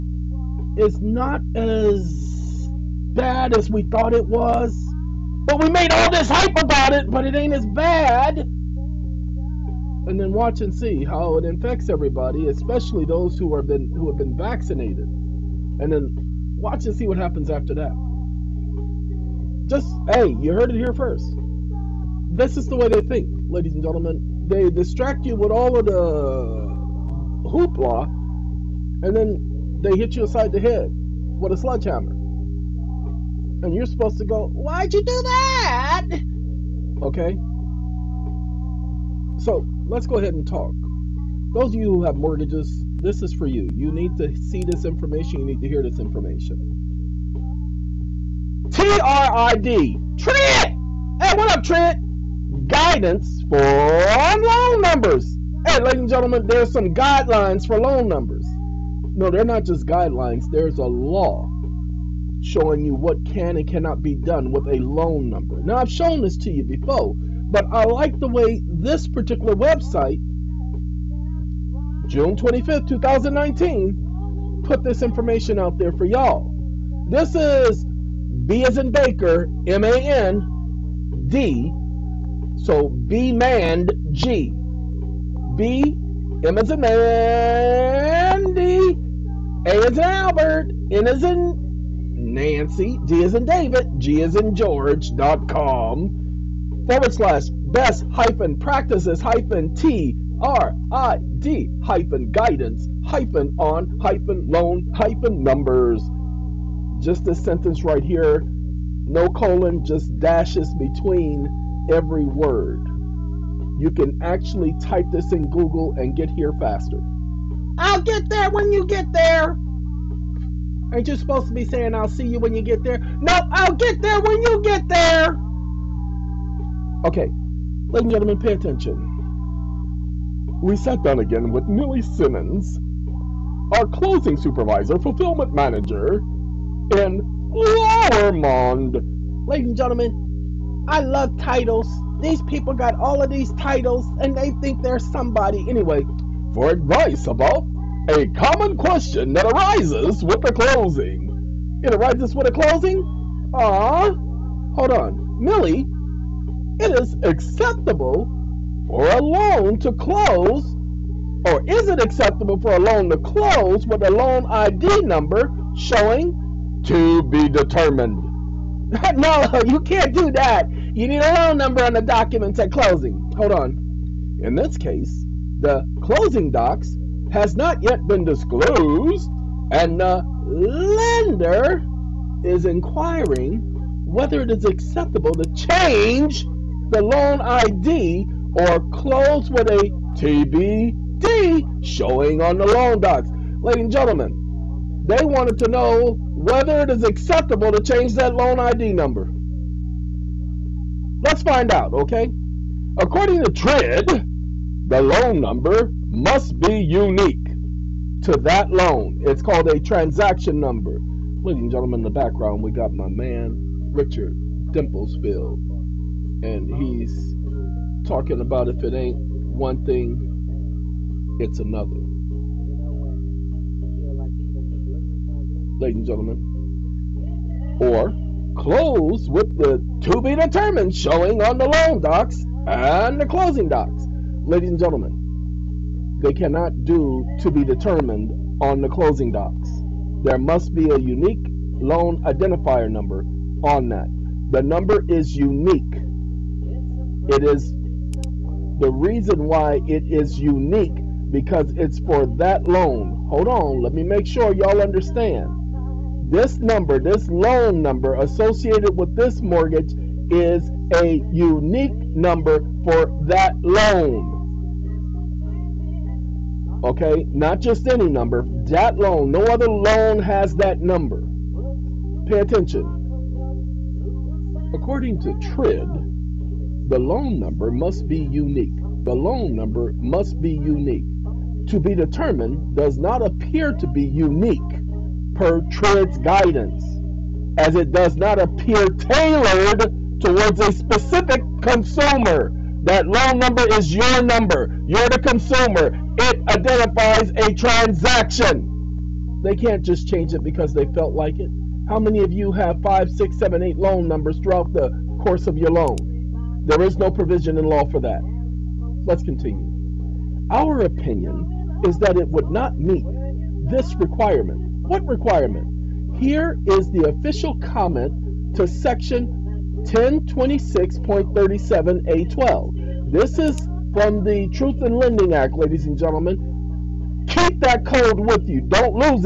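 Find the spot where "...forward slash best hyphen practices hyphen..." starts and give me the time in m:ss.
1:36.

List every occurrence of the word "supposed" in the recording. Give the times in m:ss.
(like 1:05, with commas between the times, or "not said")
0:33, 2:01.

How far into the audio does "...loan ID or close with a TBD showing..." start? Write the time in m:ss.
3:07.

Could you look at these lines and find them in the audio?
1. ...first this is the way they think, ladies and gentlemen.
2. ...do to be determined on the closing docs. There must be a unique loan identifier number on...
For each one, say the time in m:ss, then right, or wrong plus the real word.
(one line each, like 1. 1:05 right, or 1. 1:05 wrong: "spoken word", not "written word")
1. 0:20 right
2. 3:56 right.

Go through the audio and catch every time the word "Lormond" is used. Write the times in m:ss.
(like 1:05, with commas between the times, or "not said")
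2:17.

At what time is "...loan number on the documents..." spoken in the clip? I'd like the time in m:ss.
2:51.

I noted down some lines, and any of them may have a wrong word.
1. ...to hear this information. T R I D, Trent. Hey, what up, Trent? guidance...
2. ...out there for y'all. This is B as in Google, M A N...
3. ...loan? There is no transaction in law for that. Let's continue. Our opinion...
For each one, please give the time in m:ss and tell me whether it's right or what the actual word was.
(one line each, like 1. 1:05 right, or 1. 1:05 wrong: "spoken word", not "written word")
1. 0:45 right
2. 1:15 wrong: "Baker", not "Google"
3. 5:05 wrong: "provision", not "transaction".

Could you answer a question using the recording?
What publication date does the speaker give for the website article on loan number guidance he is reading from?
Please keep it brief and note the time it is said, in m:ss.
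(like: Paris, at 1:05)
June 25th, 2019, at 1:12.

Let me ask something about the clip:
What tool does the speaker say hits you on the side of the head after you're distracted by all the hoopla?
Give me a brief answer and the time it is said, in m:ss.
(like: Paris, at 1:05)
sledgehammer, at 0:31.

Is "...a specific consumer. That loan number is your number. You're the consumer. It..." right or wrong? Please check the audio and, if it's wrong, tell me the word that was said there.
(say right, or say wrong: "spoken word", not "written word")
right.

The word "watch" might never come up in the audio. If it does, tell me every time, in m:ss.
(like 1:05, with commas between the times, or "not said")
0:10, 0:16.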